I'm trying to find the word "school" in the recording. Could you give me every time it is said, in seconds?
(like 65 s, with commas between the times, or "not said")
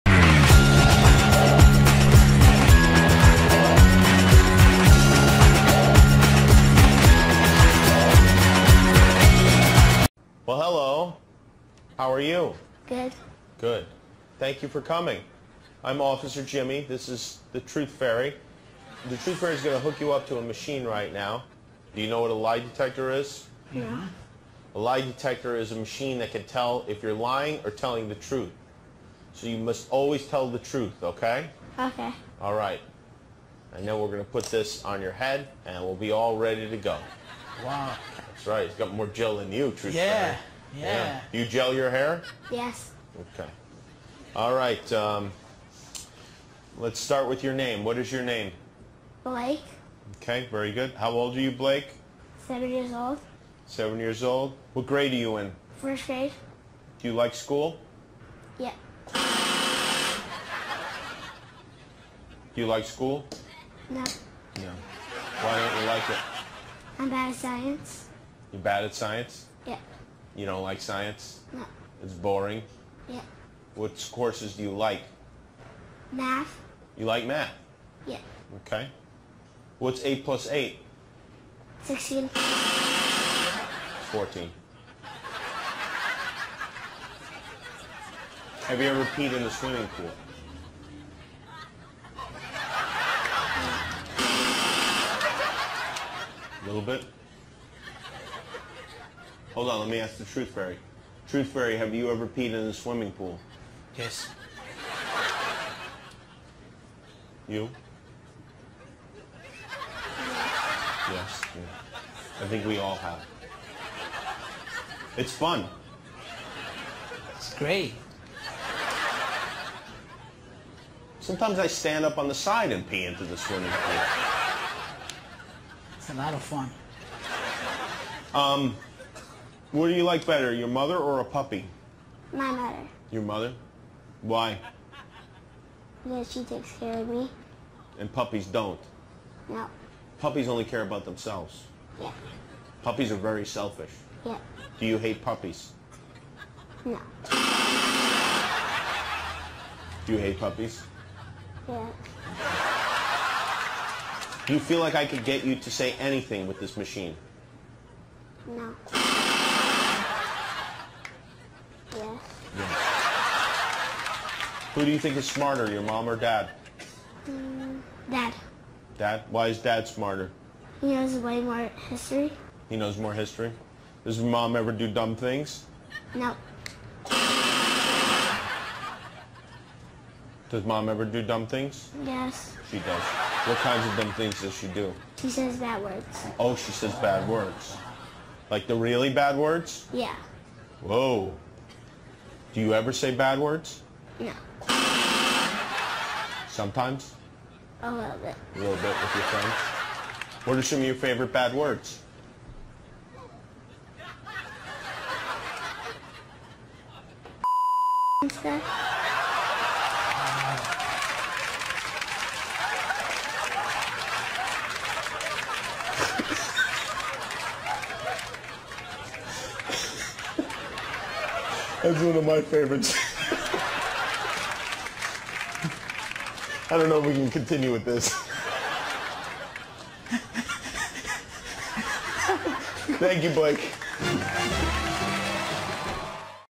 57 s, 62 s.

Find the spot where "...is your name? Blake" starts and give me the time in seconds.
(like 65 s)
47 s.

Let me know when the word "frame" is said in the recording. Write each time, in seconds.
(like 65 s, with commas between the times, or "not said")
not said.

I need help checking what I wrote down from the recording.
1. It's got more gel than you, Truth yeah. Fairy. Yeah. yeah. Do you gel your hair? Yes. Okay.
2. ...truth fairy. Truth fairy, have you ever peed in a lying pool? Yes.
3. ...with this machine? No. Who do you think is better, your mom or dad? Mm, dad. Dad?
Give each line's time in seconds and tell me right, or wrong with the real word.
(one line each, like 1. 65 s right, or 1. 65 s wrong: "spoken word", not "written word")
1. 38 s right
2. 100 s wrong: "swimming", not "lying"
3. 156 s wrong: "smarter", not "better".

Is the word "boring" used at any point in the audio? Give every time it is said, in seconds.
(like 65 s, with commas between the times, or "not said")
72 s.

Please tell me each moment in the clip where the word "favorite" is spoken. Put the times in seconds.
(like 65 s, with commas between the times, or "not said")
200 s, 222 s.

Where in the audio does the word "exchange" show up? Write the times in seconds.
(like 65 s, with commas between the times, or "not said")
not said.